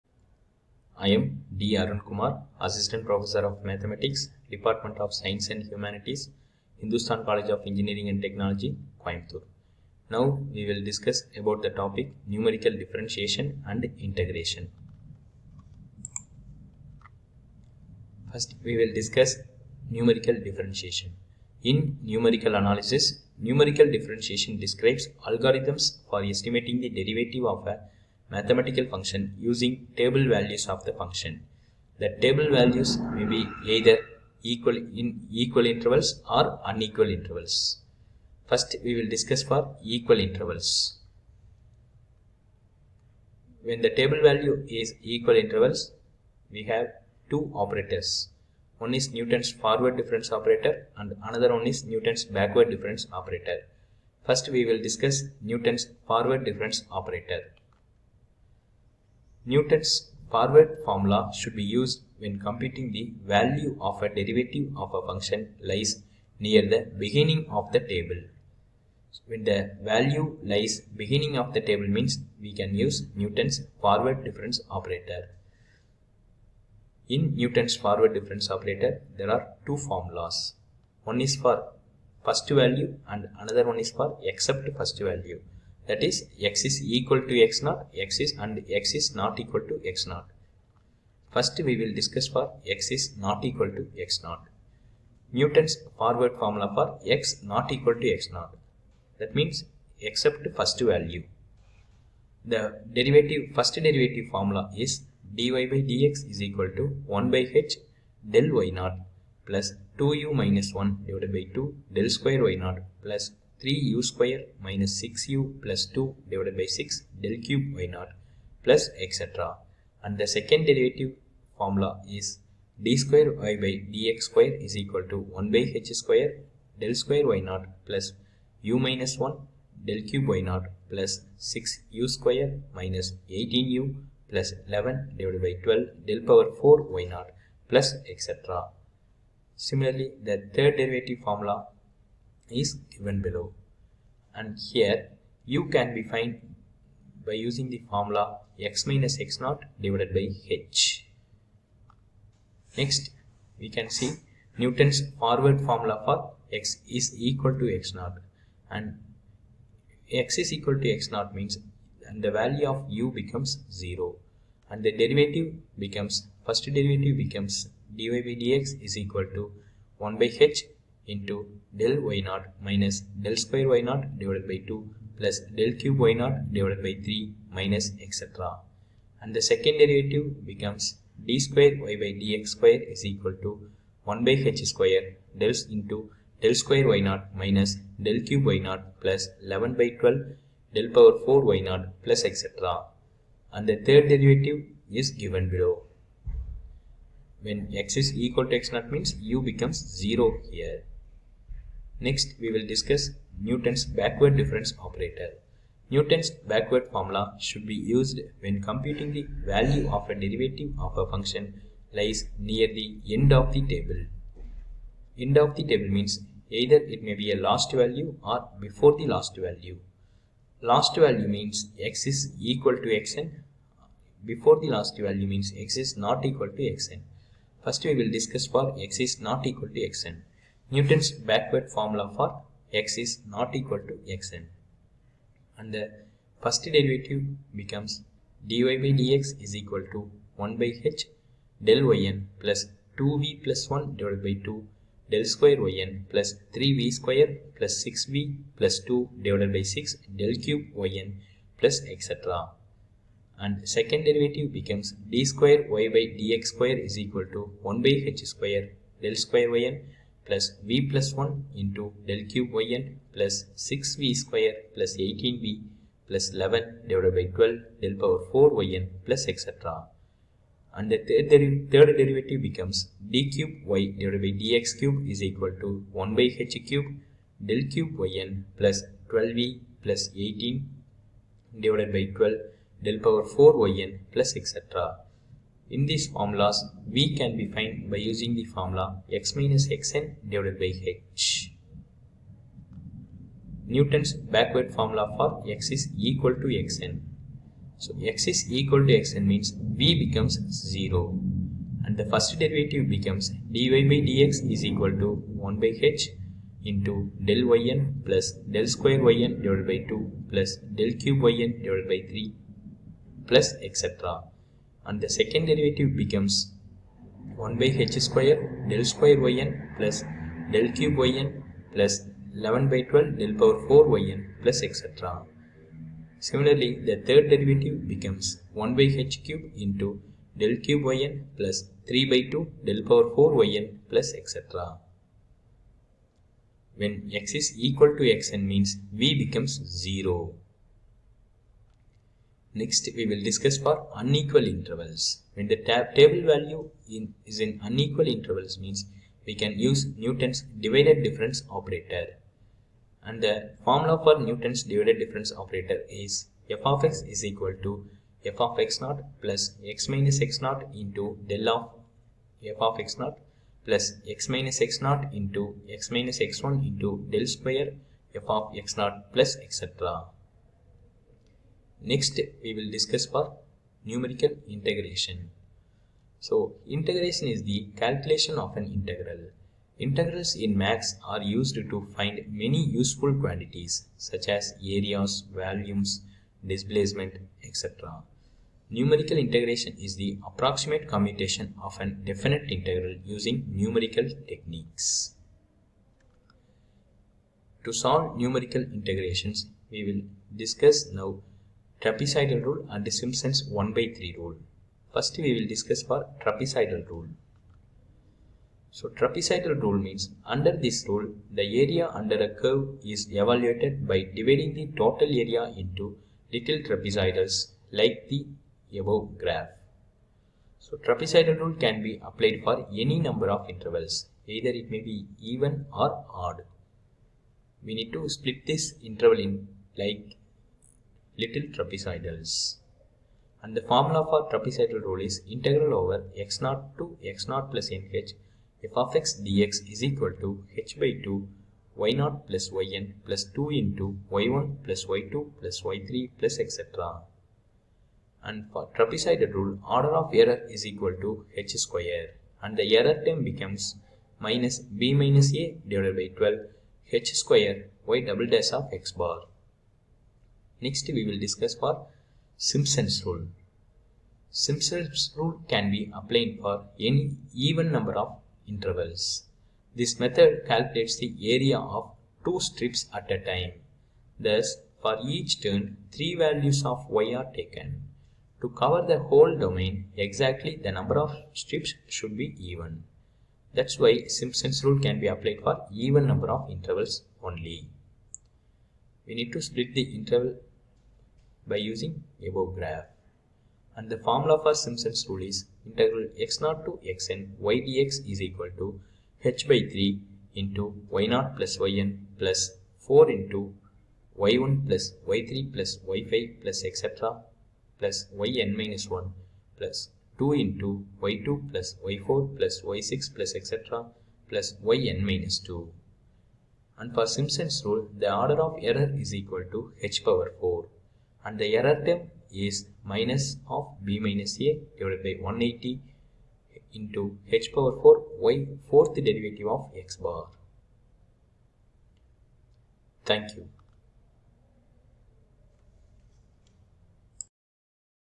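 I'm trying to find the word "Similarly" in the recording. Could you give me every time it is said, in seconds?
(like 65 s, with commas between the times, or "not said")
139 s, 326 s.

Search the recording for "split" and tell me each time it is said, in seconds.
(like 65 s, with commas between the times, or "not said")
428 s, 489 s.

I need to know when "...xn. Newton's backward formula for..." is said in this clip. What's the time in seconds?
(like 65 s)
229 s.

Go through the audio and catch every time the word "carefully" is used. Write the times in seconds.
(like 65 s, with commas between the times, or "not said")
not said.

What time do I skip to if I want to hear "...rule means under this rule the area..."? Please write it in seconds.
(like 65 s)
409 s.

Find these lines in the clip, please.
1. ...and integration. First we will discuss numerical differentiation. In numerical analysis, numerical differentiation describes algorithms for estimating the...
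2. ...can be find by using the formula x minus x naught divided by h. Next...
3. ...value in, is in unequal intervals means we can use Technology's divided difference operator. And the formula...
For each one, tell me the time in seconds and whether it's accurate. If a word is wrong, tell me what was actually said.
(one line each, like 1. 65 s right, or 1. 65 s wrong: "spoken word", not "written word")
1. 13 s right
2. 145 s right
3. 346 s wrong: "Newton", not "Technology".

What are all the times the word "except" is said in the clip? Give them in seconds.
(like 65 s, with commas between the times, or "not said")
84 s, 99 s.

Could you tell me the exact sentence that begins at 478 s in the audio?
To cover the whole domain, exactly the number of strips should be even.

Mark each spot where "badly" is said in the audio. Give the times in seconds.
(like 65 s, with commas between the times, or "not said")
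not said.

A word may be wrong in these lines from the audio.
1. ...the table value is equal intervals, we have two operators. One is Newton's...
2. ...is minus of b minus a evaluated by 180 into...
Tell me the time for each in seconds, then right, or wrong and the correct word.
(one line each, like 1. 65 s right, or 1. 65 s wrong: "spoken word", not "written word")
1. 43 s right
2. 522 s wrong: "divided", not "evaluated".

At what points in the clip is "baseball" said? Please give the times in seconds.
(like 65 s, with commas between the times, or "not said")
not said.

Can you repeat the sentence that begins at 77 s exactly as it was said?
In Newton's forward difference operator, there are two formulas.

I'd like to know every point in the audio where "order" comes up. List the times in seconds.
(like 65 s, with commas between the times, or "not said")
449 s, 518 s.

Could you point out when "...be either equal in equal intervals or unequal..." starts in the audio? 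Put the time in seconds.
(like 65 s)
33 s.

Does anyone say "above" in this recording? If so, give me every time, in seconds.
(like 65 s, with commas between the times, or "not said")
418 s, 492 s.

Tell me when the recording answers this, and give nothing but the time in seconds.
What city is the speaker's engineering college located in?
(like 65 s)
9 s.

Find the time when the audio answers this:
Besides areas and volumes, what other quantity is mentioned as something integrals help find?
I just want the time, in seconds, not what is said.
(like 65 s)
386 s.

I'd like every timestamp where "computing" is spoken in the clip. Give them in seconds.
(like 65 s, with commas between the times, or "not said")
62 s, 208 s.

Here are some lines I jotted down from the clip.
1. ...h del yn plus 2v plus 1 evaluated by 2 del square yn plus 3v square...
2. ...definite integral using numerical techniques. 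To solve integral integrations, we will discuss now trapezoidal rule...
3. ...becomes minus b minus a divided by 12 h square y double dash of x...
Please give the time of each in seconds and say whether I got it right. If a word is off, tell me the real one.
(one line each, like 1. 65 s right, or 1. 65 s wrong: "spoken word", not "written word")
1. 240 s wrong: "divided", not "evaluated"
2. 391 s wrong: "numerical", not "integral"
3. 453 s right.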